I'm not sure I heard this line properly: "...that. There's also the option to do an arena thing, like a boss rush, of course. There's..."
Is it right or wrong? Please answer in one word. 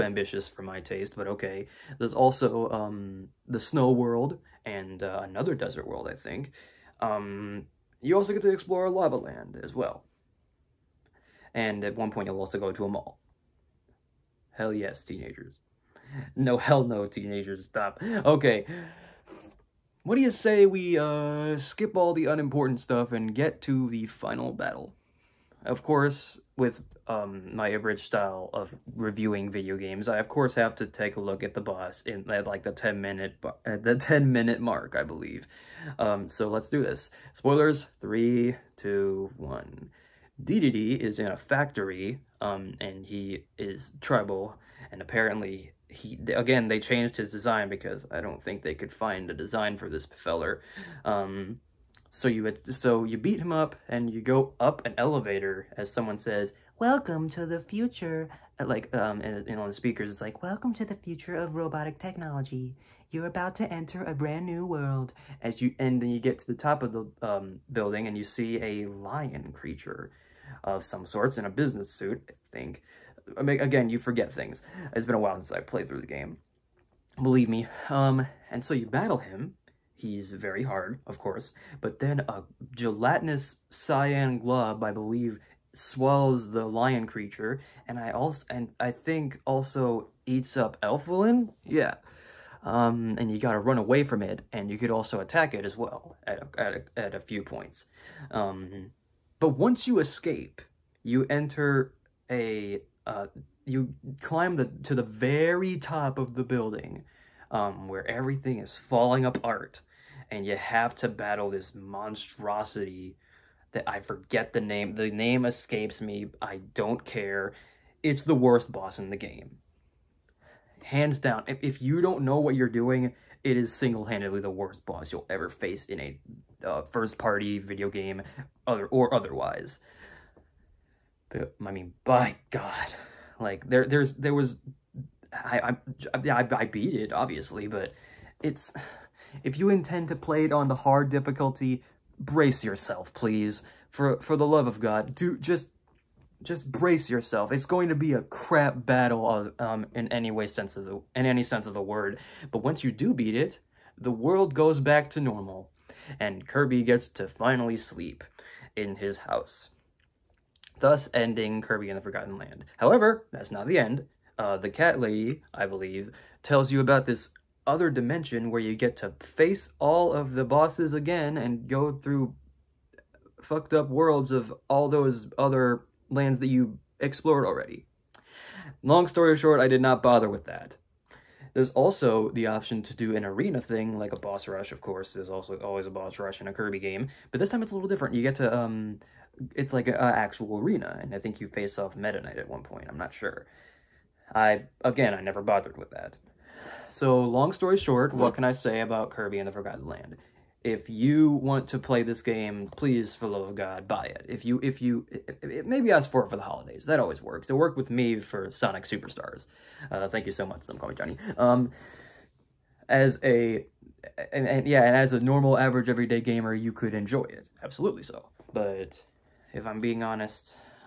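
right.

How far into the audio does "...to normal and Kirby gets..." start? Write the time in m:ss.
2:35.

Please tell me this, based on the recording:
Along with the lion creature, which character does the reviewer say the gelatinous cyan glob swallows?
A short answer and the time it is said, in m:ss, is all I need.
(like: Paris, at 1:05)
Elfilin, at 1:30.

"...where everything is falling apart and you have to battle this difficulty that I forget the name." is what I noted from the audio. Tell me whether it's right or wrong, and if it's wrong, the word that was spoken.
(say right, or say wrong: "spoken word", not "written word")
wrong: "monstrosity", not "difficulty".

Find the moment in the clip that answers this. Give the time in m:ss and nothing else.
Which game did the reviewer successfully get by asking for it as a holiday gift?
3:28.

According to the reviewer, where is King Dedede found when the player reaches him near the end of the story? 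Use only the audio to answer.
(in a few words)
a factory.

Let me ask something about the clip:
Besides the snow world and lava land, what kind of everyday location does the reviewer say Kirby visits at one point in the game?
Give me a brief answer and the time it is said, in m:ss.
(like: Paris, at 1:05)
a mall, at 0:12.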